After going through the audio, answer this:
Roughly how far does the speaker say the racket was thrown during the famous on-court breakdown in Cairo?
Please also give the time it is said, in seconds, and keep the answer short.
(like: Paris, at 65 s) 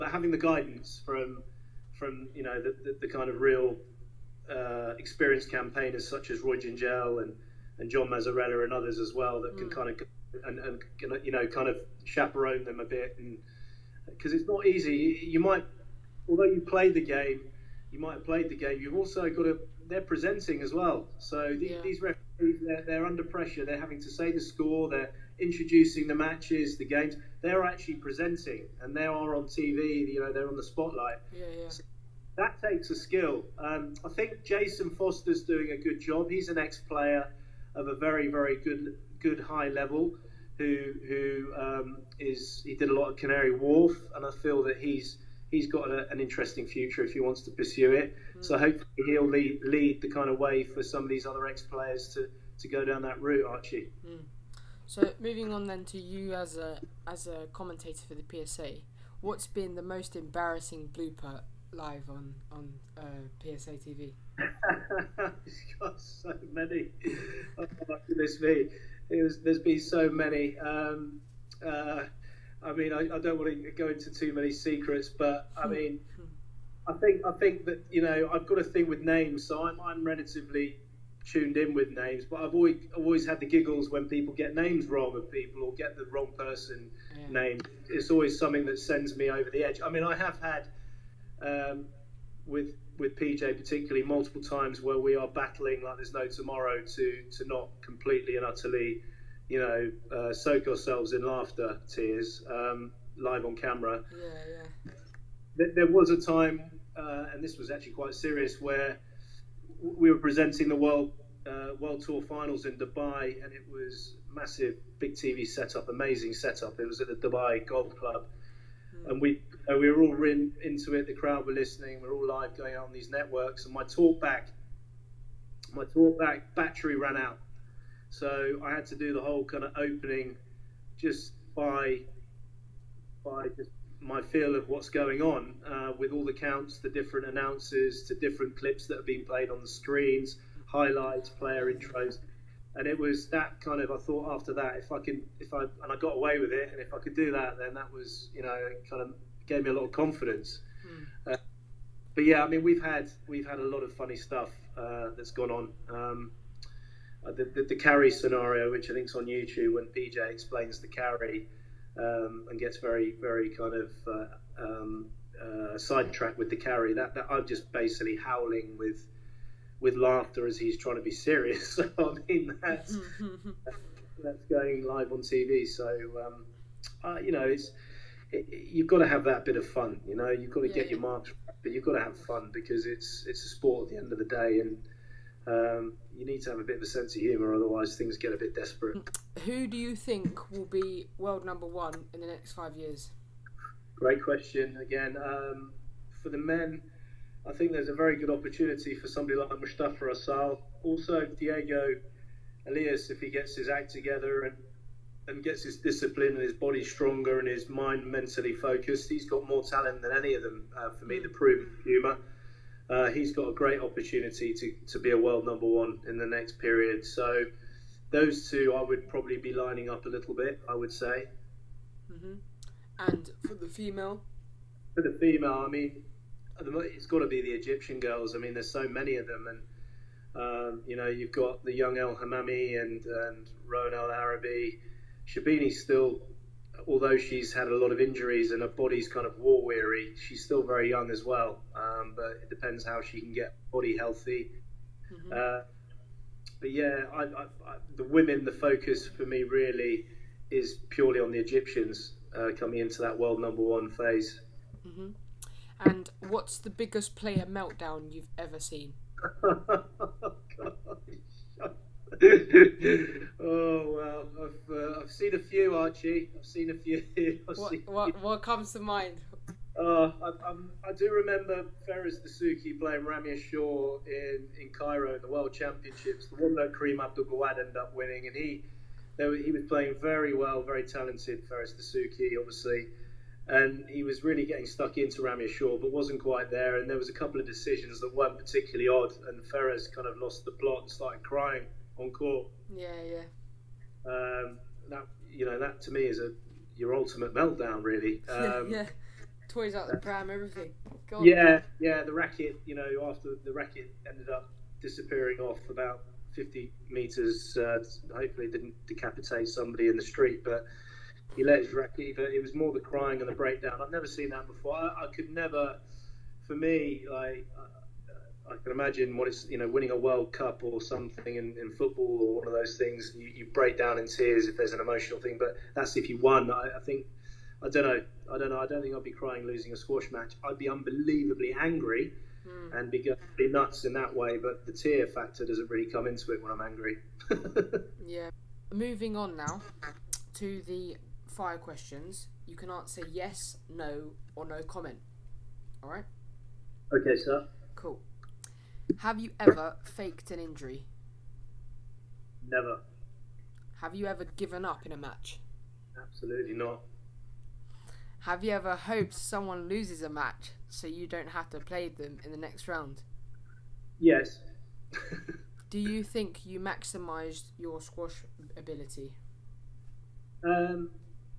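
50 meters, at 306 s.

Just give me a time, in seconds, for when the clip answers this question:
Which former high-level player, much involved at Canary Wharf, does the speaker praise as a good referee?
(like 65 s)
34 s.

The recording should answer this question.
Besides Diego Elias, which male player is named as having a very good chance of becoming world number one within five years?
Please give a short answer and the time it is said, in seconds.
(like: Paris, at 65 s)
Mustafa Asal, at 199 s.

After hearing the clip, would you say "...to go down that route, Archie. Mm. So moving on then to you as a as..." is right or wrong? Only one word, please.
right.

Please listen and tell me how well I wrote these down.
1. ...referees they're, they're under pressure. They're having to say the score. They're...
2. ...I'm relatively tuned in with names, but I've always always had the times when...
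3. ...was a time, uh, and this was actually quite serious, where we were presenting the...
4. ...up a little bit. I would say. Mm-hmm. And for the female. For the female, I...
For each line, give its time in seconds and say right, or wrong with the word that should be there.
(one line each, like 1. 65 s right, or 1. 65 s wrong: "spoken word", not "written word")
1. 22 s right
2. 79 s wrong: "giggles", not "times"
3. 105 s right
4. 219 s right.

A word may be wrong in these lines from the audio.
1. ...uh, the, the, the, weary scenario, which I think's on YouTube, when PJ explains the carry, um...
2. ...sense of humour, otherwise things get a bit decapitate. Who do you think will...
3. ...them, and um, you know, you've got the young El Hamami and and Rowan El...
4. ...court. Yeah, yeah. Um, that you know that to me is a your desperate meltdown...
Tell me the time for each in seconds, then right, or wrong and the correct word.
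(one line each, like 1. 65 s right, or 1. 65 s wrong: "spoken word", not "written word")
1. 157 s wrong: "carry", not "weary"
2. 186 s wrong: "desperate", not "decapitate"
3. 229 s right
4. 292 s wrong: "ultimate", not "desperate".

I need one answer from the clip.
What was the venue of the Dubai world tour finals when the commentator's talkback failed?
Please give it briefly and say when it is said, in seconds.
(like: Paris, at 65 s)
Dubai Golf Club, at 117 s.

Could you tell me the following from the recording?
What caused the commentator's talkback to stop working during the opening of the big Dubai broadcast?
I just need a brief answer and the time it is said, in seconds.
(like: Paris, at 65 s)
Battery ran out, at 126 s.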